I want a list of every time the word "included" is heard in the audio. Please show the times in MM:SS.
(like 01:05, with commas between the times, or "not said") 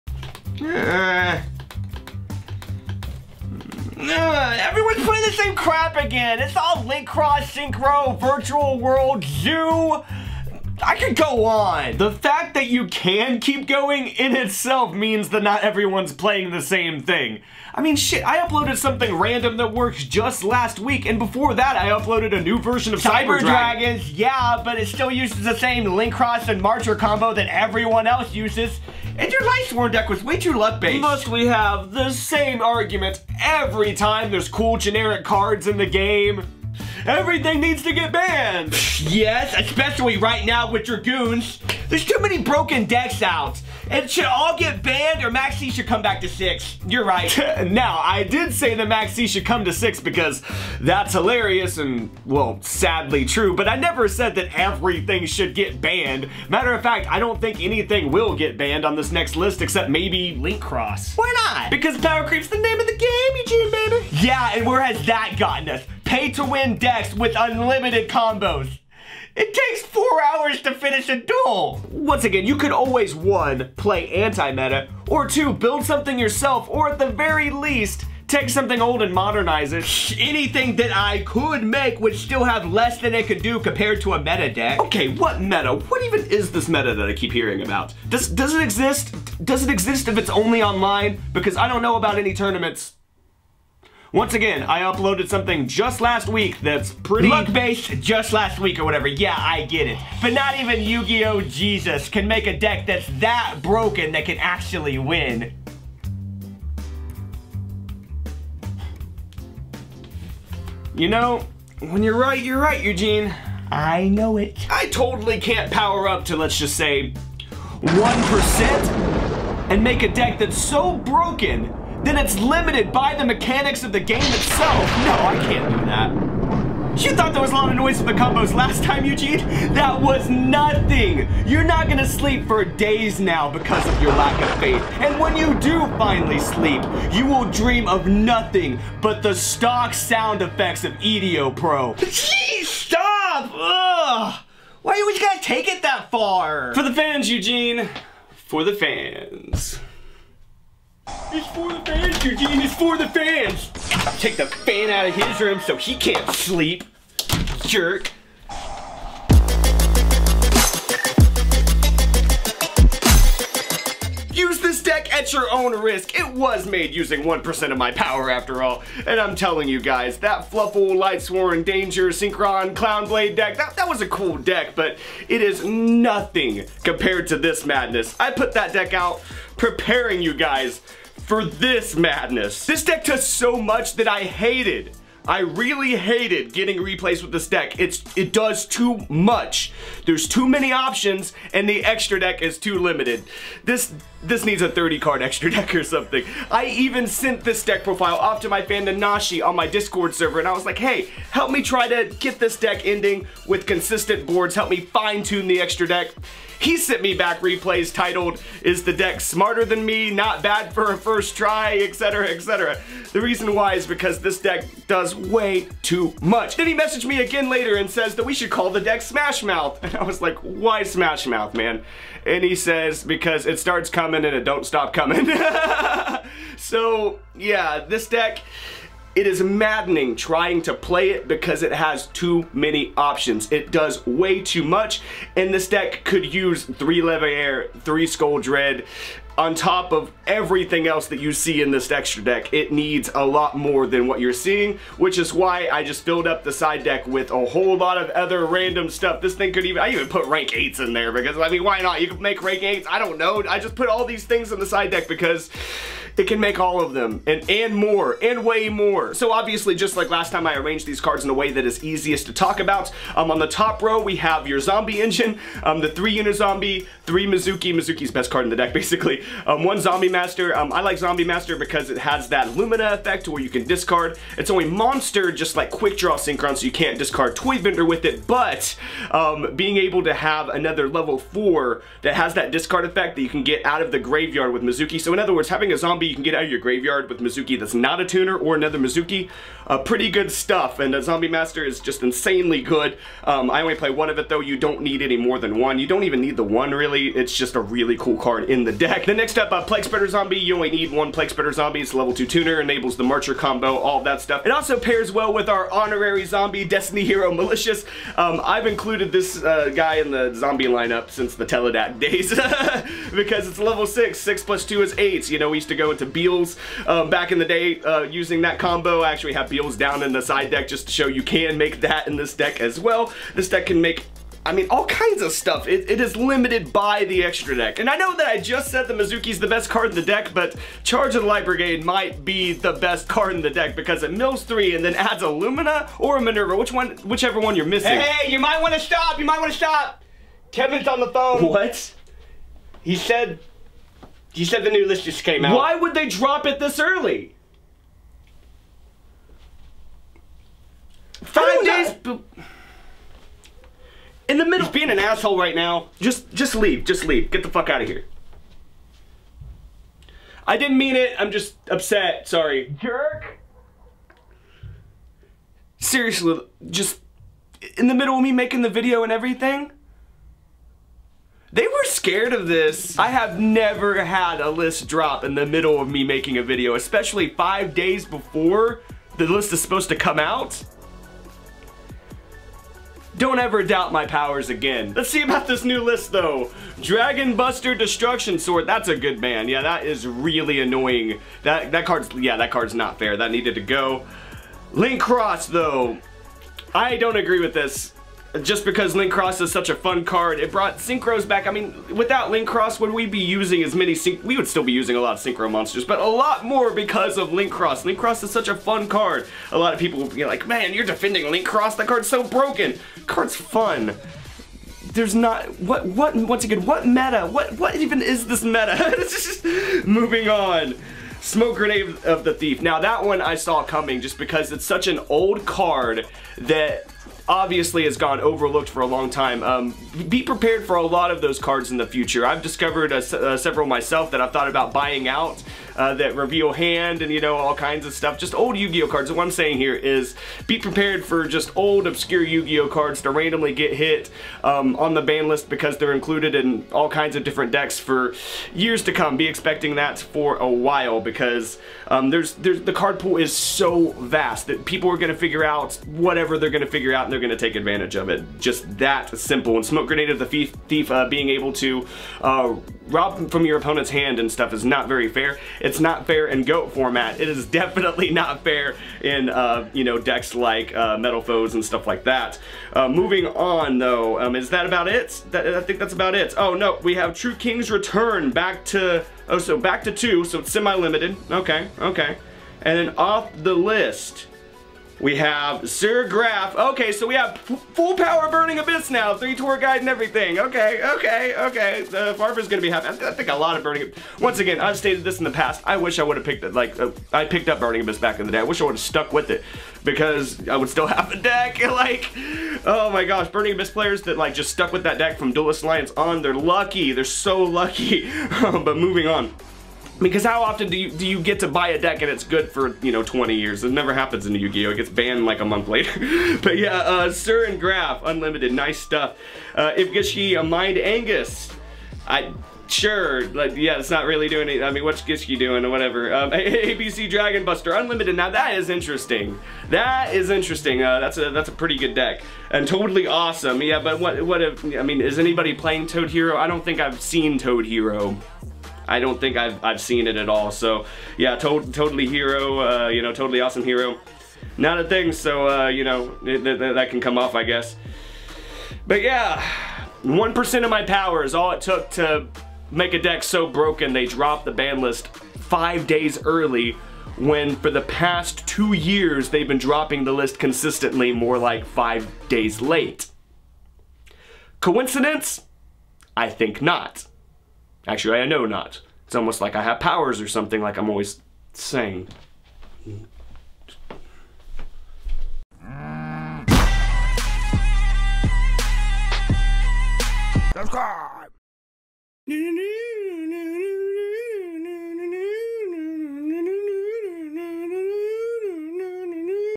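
05:08, 07:25.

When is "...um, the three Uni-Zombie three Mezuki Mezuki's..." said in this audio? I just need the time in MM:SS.
04:25.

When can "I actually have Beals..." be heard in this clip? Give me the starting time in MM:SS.
05:19.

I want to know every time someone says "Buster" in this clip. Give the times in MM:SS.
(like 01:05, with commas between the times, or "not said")
06:27, 08:47.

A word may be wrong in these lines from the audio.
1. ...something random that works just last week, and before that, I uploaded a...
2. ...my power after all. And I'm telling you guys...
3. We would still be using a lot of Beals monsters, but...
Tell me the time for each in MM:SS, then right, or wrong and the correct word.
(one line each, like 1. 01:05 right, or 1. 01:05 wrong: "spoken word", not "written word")
1. 00:18 right
2. 02:47 right
3. 06:44 wrong: "Synchro", not "Beals".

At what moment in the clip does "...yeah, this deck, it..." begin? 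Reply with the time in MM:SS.
03:47.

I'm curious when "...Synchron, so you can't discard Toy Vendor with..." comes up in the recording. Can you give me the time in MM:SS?
04:36.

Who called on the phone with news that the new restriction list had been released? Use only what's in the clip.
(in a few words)
Kevin.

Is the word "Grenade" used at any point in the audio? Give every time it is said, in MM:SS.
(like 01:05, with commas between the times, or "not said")
07:01, 07:39.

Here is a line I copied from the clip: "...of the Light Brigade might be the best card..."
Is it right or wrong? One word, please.
right.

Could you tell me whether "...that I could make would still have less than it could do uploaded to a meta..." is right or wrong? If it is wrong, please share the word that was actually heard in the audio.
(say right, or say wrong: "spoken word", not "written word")
wrong: "compared", not "uploaded".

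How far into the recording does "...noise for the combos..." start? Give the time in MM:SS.
02:07.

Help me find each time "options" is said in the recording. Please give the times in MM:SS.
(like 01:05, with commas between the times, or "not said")
03:10, 03:52.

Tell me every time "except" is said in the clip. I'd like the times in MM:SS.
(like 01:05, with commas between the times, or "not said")
00:59.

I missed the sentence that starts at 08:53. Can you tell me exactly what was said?
Yeah, but what what if I mean is anybody playing Toad Hero?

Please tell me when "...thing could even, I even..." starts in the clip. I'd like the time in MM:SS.
04:09.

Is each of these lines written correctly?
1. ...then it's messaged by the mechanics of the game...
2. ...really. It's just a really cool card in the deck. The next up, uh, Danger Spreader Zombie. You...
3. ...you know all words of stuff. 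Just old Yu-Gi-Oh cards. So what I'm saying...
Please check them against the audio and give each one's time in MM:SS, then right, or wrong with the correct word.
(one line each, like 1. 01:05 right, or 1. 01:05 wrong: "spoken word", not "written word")
1. 02:02 wrong: "limited", not "messaged"
2. 04:56 wrong: "Plague", not "Danger"
3. 07:17 wrong: "kinds", not "words".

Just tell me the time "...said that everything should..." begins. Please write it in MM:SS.
00:54.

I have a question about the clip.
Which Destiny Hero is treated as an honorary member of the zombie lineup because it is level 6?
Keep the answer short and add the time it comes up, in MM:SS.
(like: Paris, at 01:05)
Destiny Hero Malicious, at 05:06.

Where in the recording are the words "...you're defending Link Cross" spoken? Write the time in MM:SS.
06:50.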